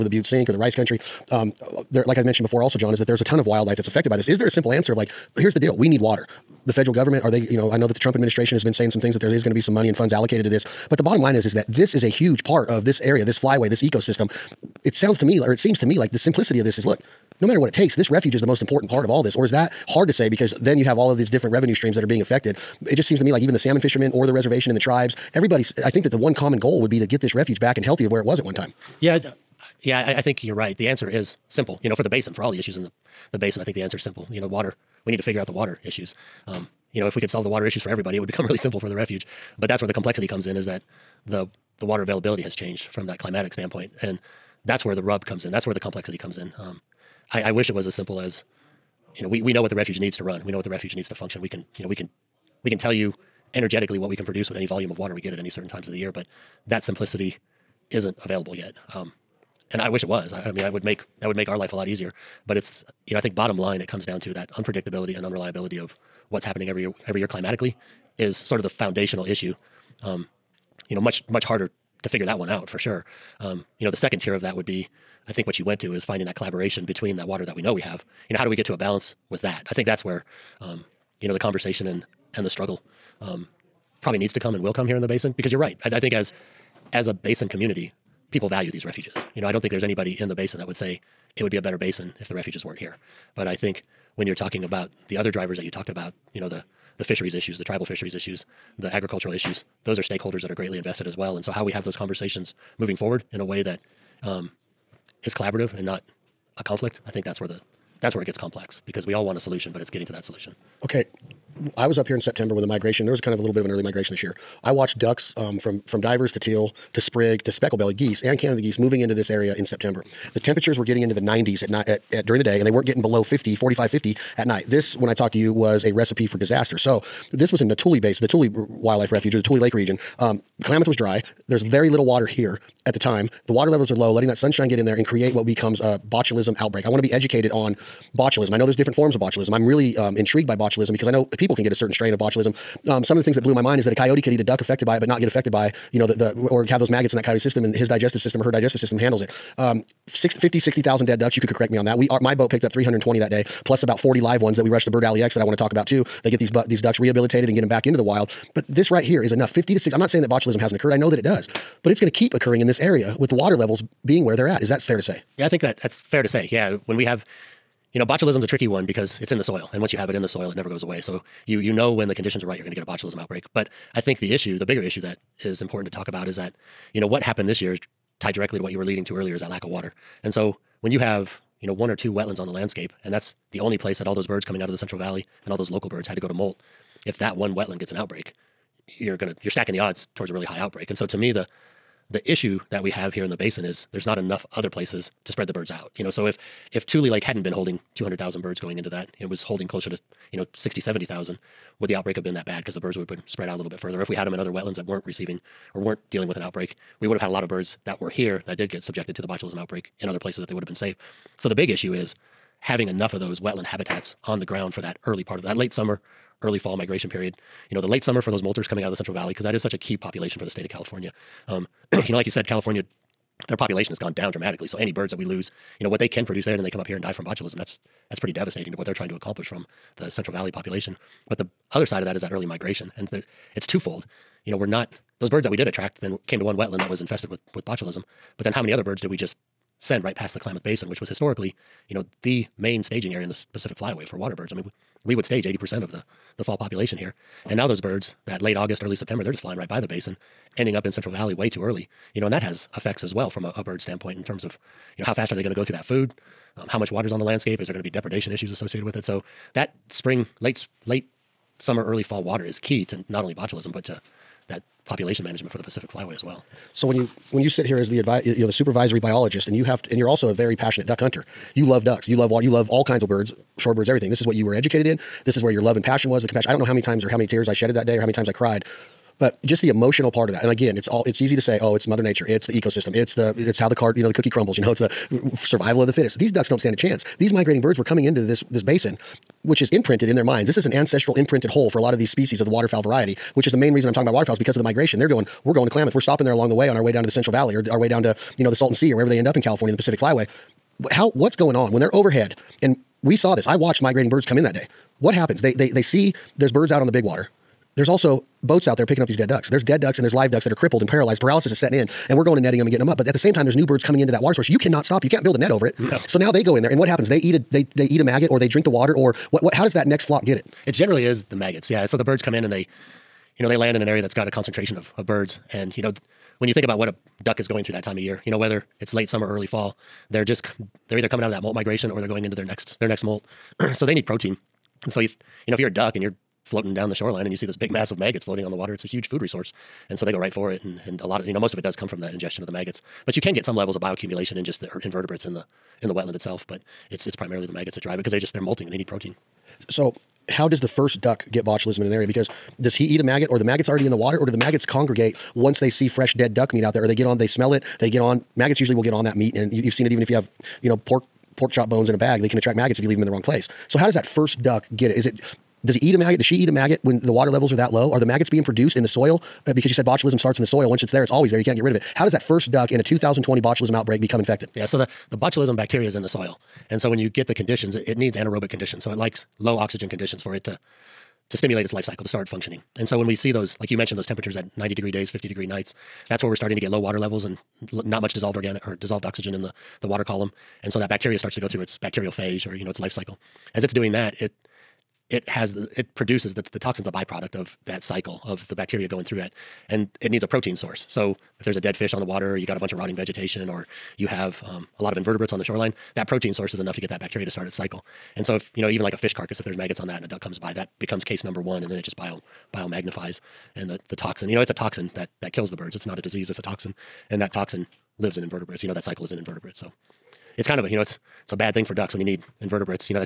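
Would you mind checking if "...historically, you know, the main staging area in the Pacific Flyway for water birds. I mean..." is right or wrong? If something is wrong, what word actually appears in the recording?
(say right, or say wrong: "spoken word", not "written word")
right.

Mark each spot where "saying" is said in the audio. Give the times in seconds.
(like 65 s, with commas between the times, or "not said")
8 s, 160 s.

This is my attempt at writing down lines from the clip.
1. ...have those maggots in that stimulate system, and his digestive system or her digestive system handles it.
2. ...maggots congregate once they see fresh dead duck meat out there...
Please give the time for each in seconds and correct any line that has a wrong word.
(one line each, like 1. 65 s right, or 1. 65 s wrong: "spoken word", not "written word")
1. 146 s wrong: "coyote", not "stimulate"
2. 354 s right.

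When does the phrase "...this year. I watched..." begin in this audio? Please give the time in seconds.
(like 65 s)
114 s.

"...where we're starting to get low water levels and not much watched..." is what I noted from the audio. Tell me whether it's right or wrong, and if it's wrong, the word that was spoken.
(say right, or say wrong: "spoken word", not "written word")
wrong: "dissolved", not "watched".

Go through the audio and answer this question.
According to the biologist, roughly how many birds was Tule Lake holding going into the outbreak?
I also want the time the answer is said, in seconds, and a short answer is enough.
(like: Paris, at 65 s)
200,000, at 197 s.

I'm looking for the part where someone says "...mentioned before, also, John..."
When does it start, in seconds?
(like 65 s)
2 s.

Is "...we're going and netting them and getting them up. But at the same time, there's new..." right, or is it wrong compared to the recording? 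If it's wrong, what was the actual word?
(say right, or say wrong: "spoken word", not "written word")
right.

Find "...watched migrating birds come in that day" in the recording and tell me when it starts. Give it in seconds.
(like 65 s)
303 s.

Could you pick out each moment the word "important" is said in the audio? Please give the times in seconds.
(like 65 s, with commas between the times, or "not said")
18 s, 175 s.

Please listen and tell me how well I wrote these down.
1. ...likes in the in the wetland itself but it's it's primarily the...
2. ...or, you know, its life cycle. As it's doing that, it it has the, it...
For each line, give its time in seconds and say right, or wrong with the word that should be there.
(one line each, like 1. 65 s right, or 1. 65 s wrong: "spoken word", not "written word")
1. 344 s wrong: "invertebrates", not "likes"
2. 392 s right.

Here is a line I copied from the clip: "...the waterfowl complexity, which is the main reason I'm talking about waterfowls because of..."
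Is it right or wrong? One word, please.
wrong.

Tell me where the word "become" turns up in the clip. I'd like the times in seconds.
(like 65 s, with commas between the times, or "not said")
38 s, 135 s, 374 s, 410 s.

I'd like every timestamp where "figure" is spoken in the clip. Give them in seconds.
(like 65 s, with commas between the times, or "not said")
35 s, 72 s.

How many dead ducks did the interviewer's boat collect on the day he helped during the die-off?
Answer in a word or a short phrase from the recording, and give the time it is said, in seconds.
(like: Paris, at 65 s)
320, at 152 s.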